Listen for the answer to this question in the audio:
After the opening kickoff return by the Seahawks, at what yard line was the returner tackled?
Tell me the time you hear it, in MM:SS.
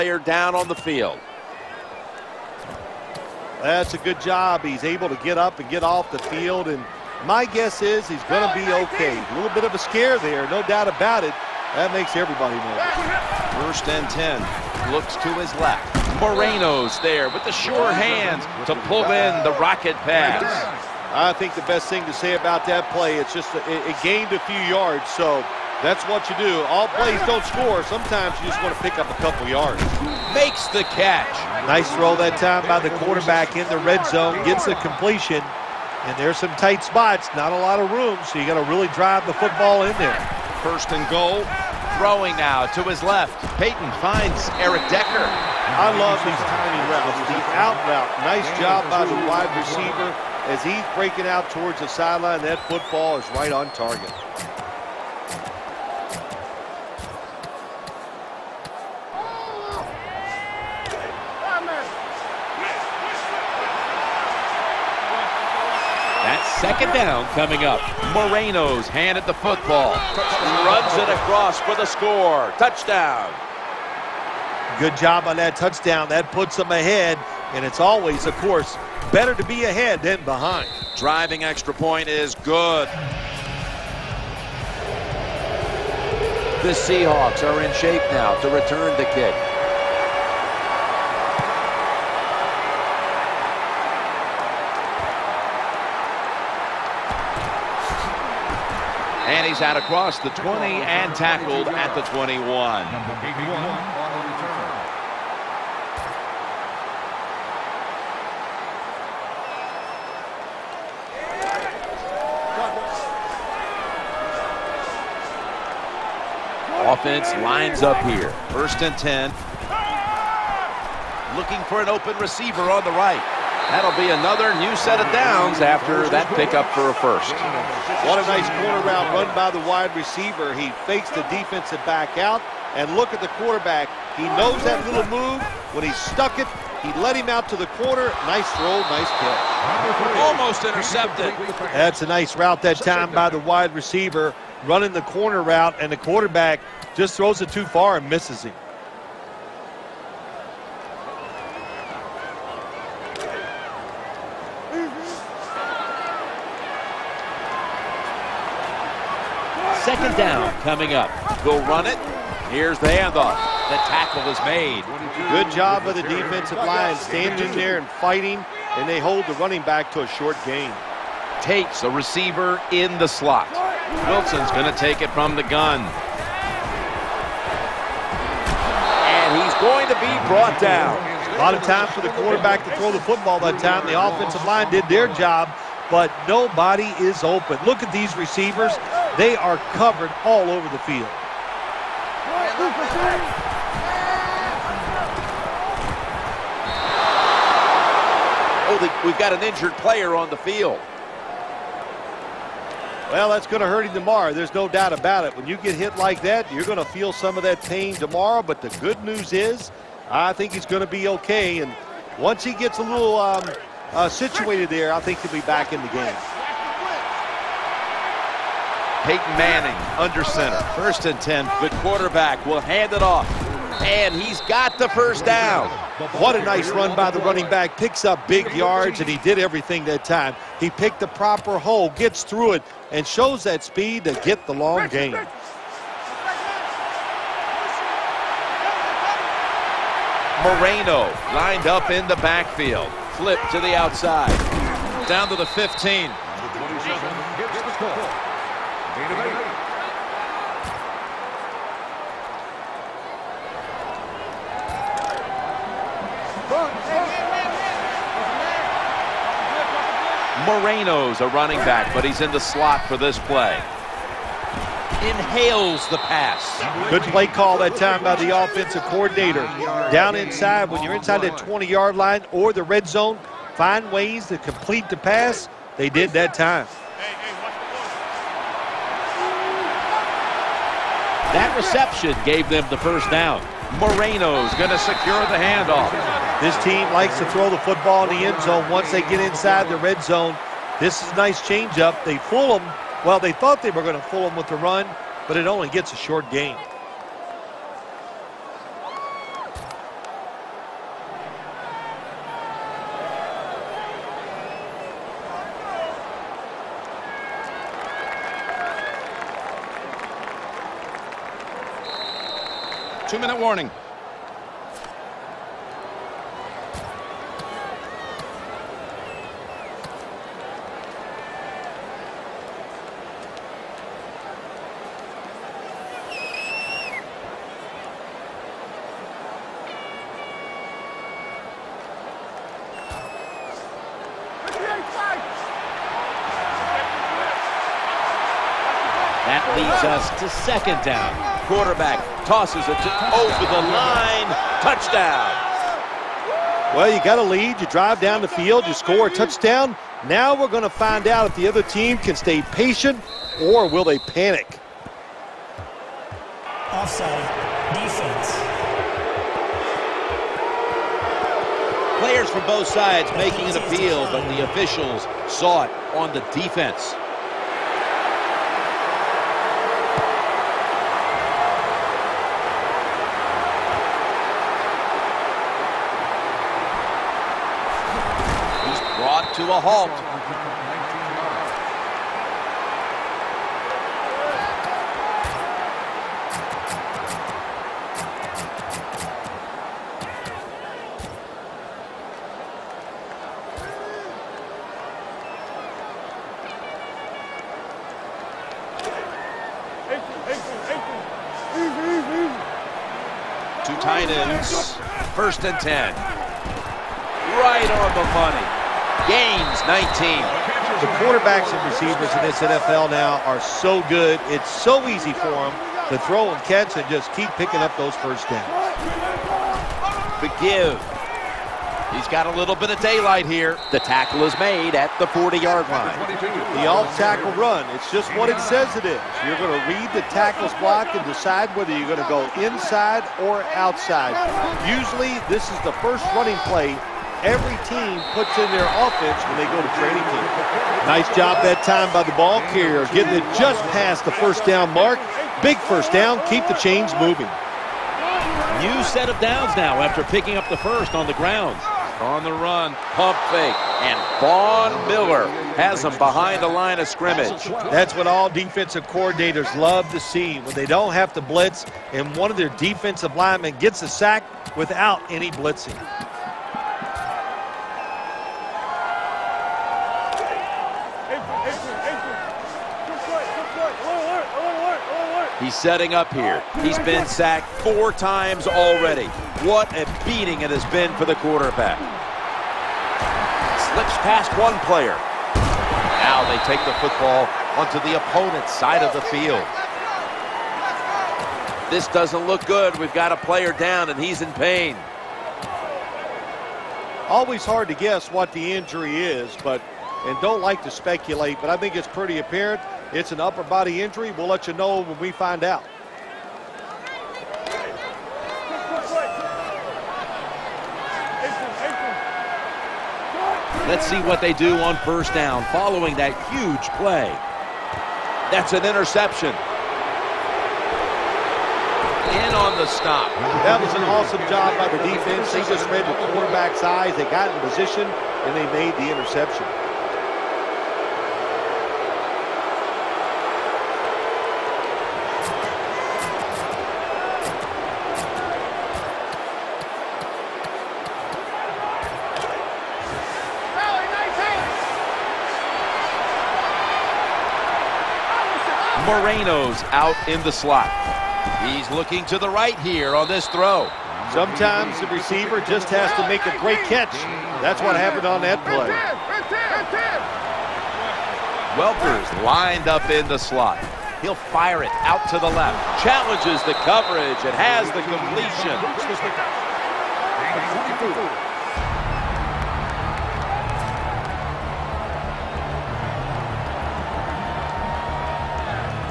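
01:41.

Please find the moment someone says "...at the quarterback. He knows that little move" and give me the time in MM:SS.
02:13.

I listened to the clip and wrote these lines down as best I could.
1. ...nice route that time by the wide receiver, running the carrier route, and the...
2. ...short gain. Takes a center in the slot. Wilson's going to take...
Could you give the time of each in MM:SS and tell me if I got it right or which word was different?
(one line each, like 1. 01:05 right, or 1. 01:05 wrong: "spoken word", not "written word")
1. 02:22 wrong: "corner", not "carrier"
2. 02:50 wrong: "receiver", not "center".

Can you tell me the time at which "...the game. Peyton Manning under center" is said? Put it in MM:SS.
03:35.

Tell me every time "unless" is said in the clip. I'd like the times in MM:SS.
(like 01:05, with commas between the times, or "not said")
not said.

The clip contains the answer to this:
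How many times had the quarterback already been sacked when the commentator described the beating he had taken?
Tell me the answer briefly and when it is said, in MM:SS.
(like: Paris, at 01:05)
4, at 07:57.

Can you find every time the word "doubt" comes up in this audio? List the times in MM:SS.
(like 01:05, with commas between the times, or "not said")
00:10, 03:24.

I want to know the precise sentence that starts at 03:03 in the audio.
The offensive line did their job, but nobody is open.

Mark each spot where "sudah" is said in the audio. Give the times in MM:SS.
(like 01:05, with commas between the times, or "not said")
not said.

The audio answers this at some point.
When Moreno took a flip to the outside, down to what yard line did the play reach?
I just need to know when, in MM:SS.
04:05.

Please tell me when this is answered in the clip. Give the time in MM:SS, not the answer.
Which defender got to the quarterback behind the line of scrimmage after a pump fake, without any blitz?
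07:34.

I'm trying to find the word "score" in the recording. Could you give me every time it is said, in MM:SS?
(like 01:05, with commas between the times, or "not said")
00:27, 01:11, 05:48.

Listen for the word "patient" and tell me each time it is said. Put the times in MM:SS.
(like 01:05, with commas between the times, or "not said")
05:52.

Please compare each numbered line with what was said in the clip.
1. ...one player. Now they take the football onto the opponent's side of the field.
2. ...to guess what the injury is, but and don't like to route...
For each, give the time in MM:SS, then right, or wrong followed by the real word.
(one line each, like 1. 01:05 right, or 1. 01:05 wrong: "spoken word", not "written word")
1. 08:04 right
2. 08:17 wrong: "speculate", not "route".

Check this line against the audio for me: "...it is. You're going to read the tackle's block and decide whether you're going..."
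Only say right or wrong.
right.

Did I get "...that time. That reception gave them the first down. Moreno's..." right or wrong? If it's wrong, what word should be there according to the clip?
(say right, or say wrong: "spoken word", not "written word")
right.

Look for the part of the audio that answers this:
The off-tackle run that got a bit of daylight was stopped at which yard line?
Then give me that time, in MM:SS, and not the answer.
07:04.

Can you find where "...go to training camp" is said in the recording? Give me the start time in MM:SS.
07:19.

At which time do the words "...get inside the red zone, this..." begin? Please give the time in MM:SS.
04:49.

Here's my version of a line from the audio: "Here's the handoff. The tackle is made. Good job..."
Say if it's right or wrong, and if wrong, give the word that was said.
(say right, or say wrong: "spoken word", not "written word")
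right.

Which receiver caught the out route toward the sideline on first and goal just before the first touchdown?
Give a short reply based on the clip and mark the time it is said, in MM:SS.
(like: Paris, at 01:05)
Eric Decker, at 00:44.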